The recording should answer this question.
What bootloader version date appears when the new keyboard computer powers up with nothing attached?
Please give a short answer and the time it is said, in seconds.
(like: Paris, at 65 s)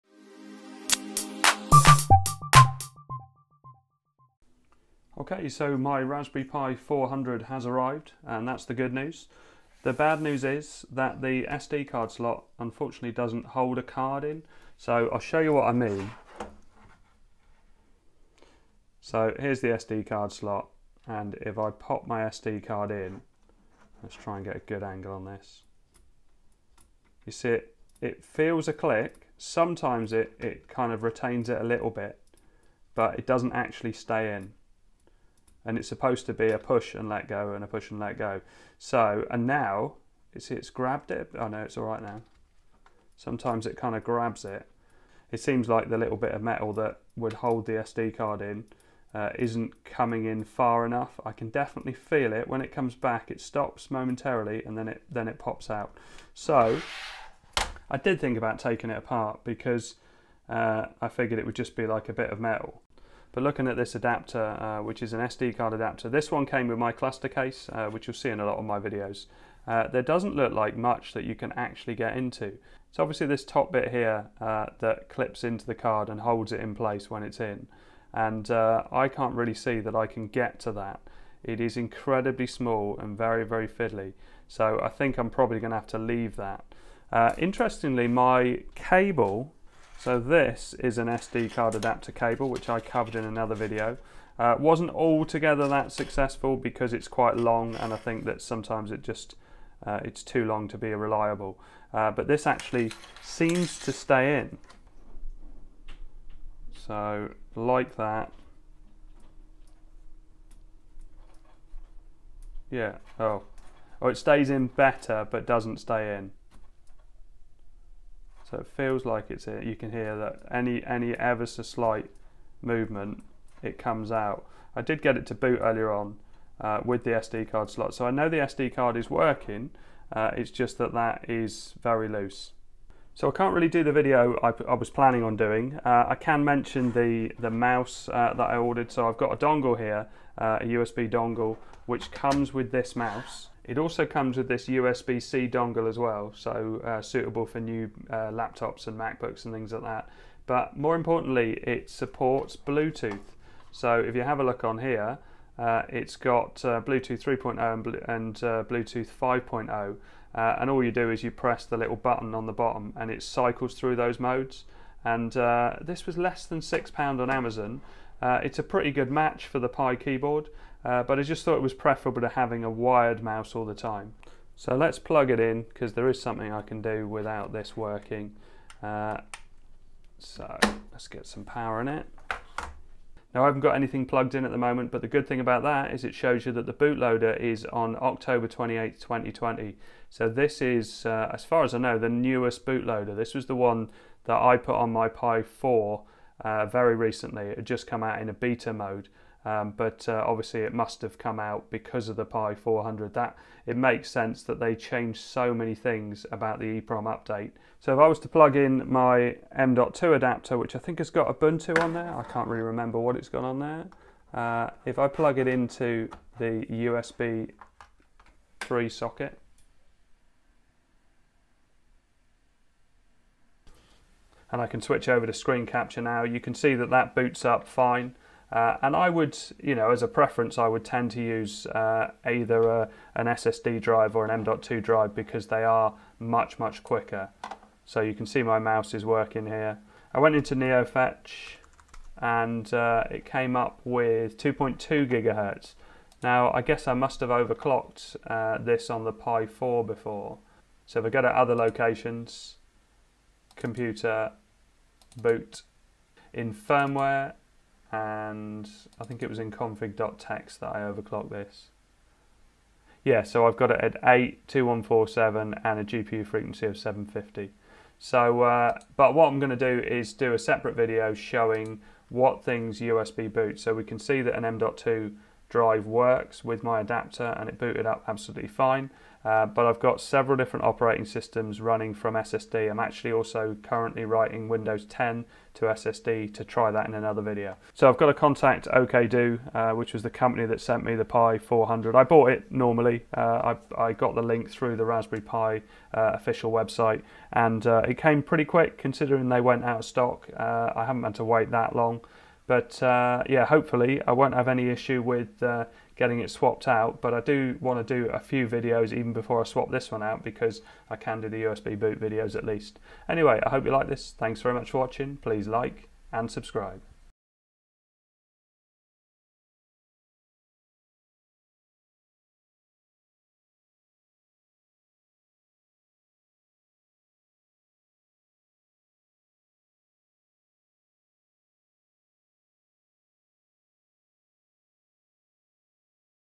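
October 28, 2020, at 188 s.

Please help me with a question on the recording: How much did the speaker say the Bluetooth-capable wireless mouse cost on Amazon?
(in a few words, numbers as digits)
less than £6.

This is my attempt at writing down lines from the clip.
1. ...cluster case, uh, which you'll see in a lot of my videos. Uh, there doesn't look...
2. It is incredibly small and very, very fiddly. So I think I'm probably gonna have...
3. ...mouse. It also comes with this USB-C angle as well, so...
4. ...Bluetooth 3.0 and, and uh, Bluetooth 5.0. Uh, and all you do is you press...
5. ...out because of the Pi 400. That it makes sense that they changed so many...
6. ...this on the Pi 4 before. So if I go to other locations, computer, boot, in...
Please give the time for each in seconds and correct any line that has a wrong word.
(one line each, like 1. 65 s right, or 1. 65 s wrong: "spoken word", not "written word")
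1. 66 s right
2. 81 s right
3. 142 s wrong: "dongle", not "angle"
4. 156 s right
5. 201 s right
6. 248 s right.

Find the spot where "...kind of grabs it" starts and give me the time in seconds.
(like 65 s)
43 s.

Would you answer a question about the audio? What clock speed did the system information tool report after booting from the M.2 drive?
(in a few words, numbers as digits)
2.2 gigahertz.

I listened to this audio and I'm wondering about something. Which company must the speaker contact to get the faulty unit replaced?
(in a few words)
OKDo.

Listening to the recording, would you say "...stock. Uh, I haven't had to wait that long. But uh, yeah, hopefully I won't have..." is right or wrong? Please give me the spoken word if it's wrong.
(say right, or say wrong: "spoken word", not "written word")
right.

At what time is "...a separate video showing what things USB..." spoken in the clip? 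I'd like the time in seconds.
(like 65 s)
270 s.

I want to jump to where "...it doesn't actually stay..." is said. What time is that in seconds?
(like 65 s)
33 s.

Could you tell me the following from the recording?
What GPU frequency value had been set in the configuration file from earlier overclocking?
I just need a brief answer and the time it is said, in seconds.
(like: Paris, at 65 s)
750, at 266 s.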